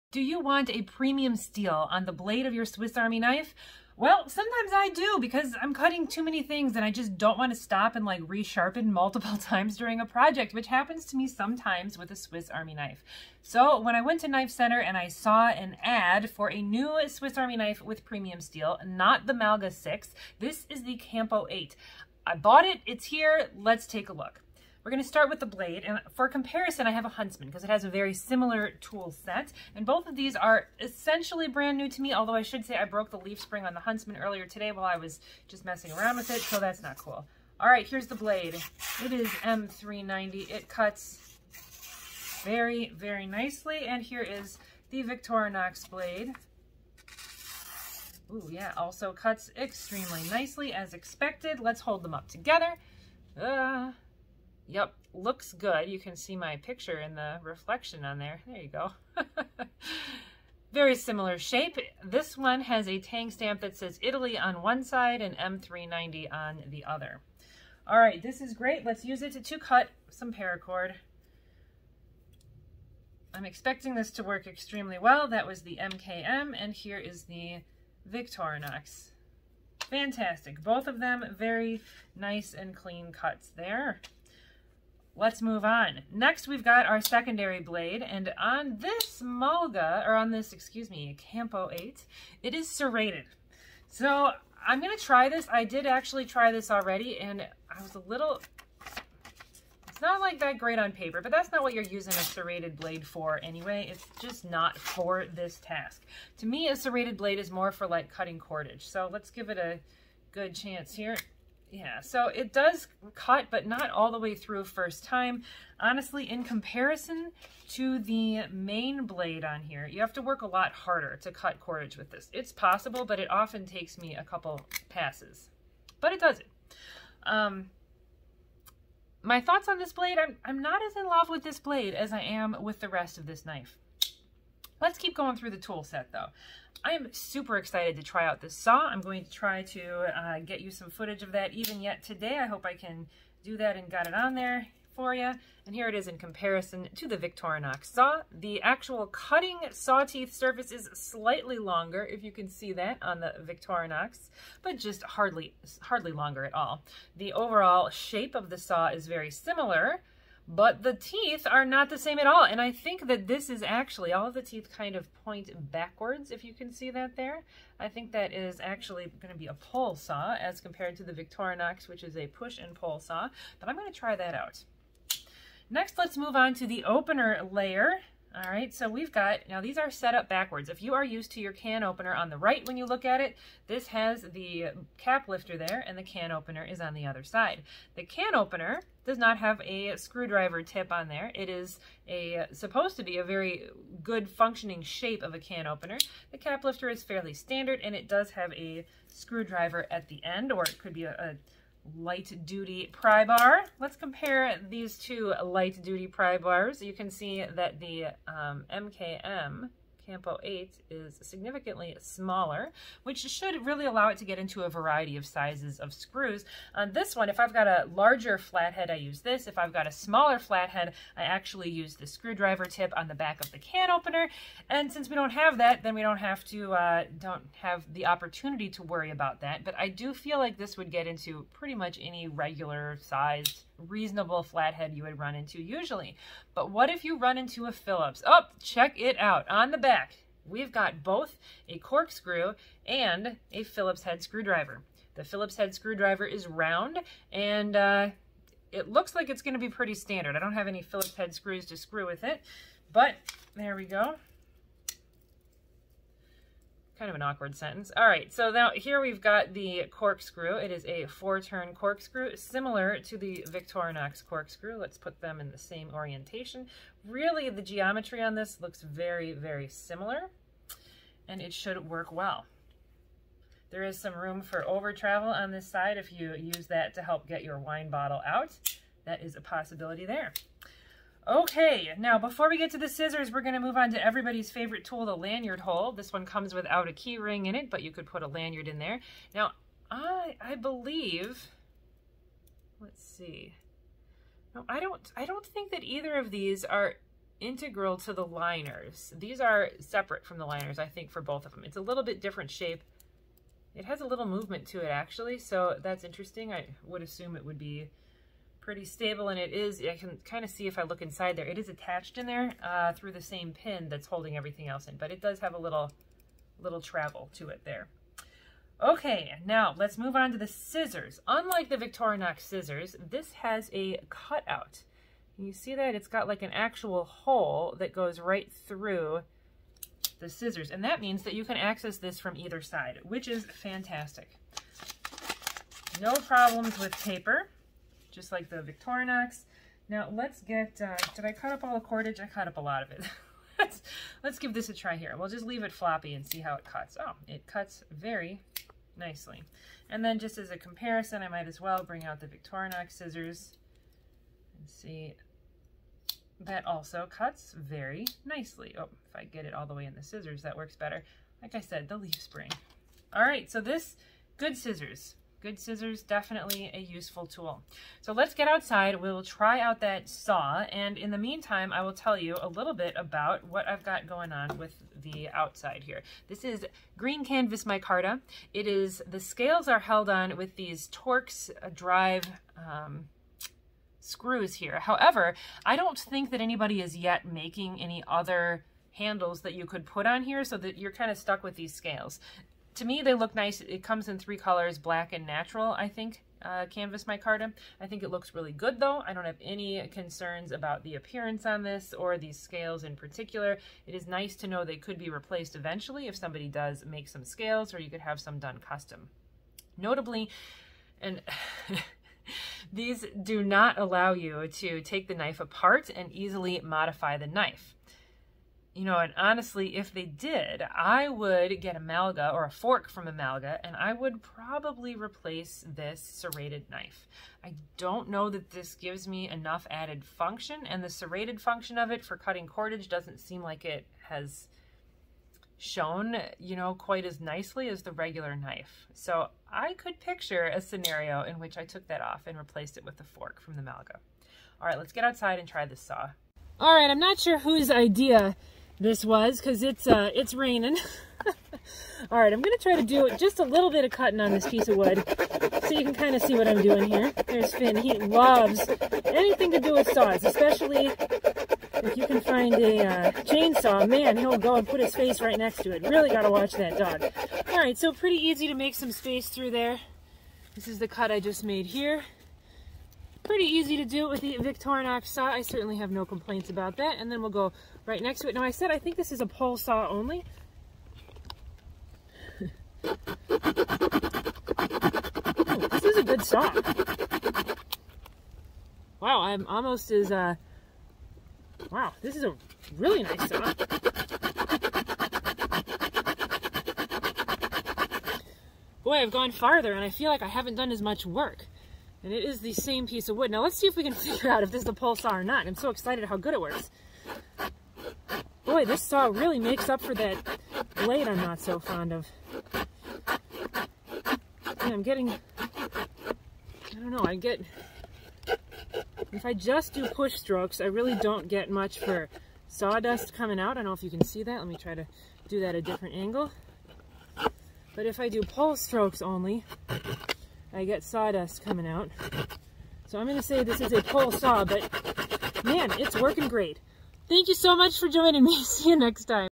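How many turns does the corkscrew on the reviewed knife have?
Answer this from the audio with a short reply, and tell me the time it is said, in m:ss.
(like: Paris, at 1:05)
4, at 4:21.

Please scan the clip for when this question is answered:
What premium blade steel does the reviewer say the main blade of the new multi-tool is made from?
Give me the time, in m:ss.
0:39.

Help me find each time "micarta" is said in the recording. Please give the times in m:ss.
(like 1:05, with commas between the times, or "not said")
6:17, 6:37.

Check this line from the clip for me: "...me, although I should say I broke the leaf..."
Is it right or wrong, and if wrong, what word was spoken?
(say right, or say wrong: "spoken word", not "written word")
right.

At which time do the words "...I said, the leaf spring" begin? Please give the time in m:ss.
6:01.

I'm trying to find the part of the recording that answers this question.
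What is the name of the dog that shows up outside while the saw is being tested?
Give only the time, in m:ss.
7:37.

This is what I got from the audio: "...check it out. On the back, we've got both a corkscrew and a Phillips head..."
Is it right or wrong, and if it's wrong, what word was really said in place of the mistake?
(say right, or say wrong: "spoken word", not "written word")
right.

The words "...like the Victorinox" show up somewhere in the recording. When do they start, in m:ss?
5:38.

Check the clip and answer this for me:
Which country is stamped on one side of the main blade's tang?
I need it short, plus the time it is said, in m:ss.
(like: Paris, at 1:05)
Italy, at 1:04.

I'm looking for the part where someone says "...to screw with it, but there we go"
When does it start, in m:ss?
4:11.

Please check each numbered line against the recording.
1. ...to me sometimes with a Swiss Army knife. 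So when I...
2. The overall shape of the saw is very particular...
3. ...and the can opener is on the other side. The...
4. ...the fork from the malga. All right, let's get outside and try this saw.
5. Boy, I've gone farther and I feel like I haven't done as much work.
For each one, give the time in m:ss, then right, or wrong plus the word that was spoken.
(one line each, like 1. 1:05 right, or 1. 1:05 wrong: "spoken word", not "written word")
1. 0:11 right
2. 2:37 wrong: "similar", not "particular"
3. 3:05 right
4. 7:22 right
5. 8:18 right.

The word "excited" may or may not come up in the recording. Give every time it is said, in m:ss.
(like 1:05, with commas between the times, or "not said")
2:17, 8:25.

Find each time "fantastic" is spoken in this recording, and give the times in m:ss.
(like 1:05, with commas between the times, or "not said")
1:19, 5:33.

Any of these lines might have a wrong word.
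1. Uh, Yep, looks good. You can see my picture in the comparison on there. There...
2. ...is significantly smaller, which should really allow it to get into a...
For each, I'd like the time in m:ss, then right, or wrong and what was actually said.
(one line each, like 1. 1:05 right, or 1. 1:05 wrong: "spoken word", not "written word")
1. 0:53 wrong: "reflection", not "comparison"
2. 3:30 right.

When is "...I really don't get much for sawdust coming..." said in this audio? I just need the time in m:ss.
8:40.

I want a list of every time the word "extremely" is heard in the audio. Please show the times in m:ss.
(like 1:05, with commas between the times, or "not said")
0:49, 1:14.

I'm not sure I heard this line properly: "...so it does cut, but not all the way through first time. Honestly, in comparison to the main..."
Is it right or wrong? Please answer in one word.
right.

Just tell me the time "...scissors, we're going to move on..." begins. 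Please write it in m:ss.
4:42.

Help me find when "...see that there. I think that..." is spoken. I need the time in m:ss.
2:46.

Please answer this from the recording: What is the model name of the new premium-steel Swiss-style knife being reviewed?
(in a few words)
Campo 8.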